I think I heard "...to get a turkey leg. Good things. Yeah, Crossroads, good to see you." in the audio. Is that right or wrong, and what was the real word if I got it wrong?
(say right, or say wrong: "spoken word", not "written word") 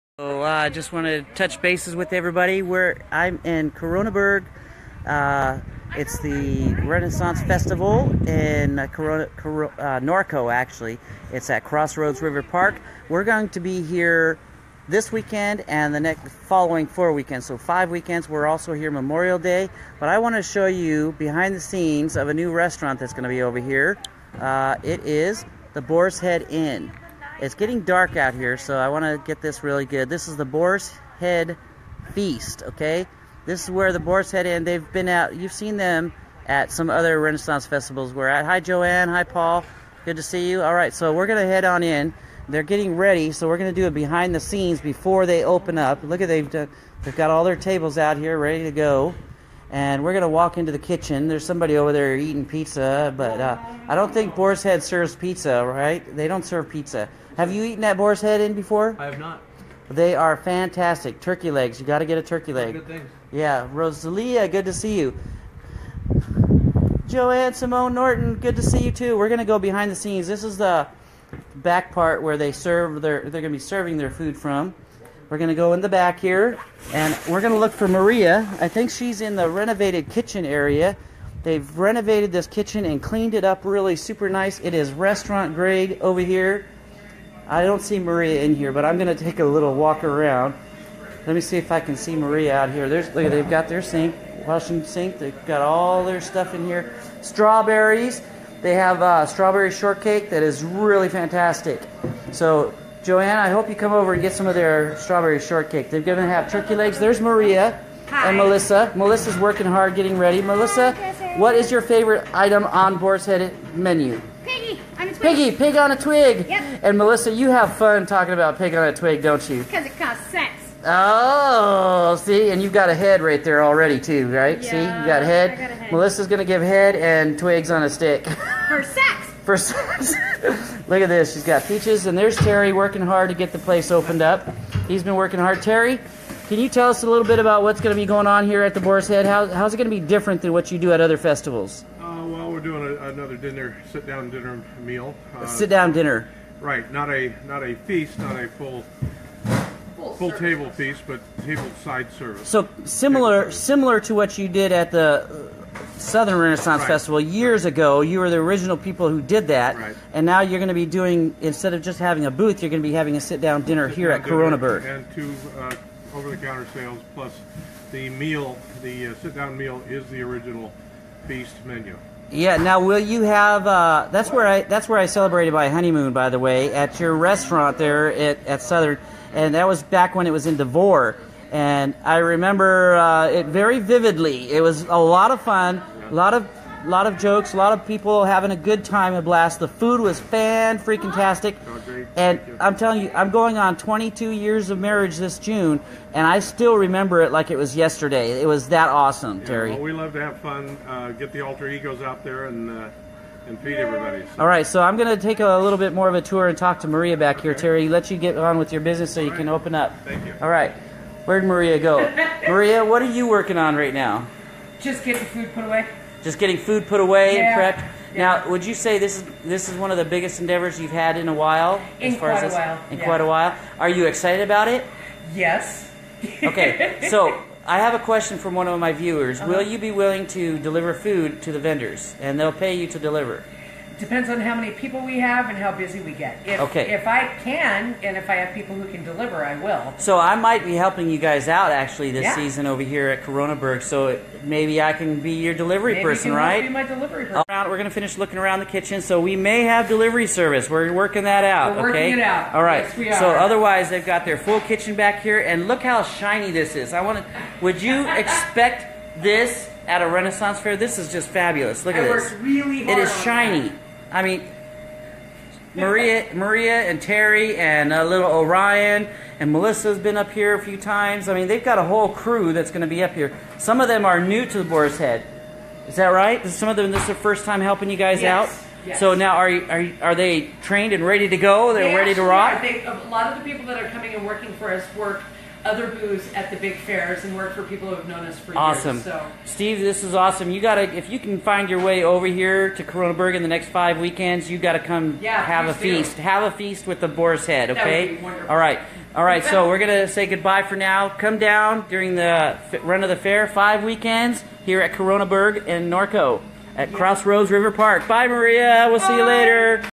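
wrong: "Rosalia", not "Crossroads".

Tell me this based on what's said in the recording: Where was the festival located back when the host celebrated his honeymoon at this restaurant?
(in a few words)
Devore.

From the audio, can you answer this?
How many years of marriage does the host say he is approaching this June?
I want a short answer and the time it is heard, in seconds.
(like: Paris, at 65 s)
22, at 193 s.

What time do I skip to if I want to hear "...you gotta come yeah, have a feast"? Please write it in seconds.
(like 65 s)
294 s.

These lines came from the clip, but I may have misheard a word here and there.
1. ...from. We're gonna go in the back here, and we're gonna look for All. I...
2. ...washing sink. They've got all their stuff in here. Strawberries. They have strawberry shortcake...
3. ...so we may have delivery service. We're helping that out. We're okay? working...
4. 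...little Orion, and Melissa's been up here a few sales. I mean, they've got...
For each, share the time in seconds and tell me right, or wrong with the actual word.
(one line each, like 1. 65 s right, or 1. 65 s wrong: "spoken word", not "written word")
1. 74 s wrong: "Maria", not "All"
2. 94 s right
3. 249 s wrong: "working", not "helping"
4. 268 s wrong: "times", not "sales".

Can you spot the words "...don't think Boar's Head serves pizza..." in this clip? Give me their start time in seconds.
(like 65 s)
53 s.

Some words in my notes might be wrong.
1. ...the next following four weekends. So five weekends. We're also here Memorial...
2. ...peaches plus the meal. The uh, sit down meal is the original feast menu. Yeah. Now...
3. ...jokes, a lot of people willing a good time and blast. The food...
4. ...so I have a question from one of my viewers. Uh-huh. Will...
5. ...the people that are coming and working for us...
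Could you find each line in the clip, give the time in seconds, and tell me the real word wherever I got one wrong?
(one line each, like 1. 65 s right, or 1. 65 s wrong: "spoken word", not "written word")
1. 15 s right
2. 166 s wrong: "sales", not "peaches"
3. 187 s wrong: "having", not "willing"
4. 227 s right
5. 283 s right.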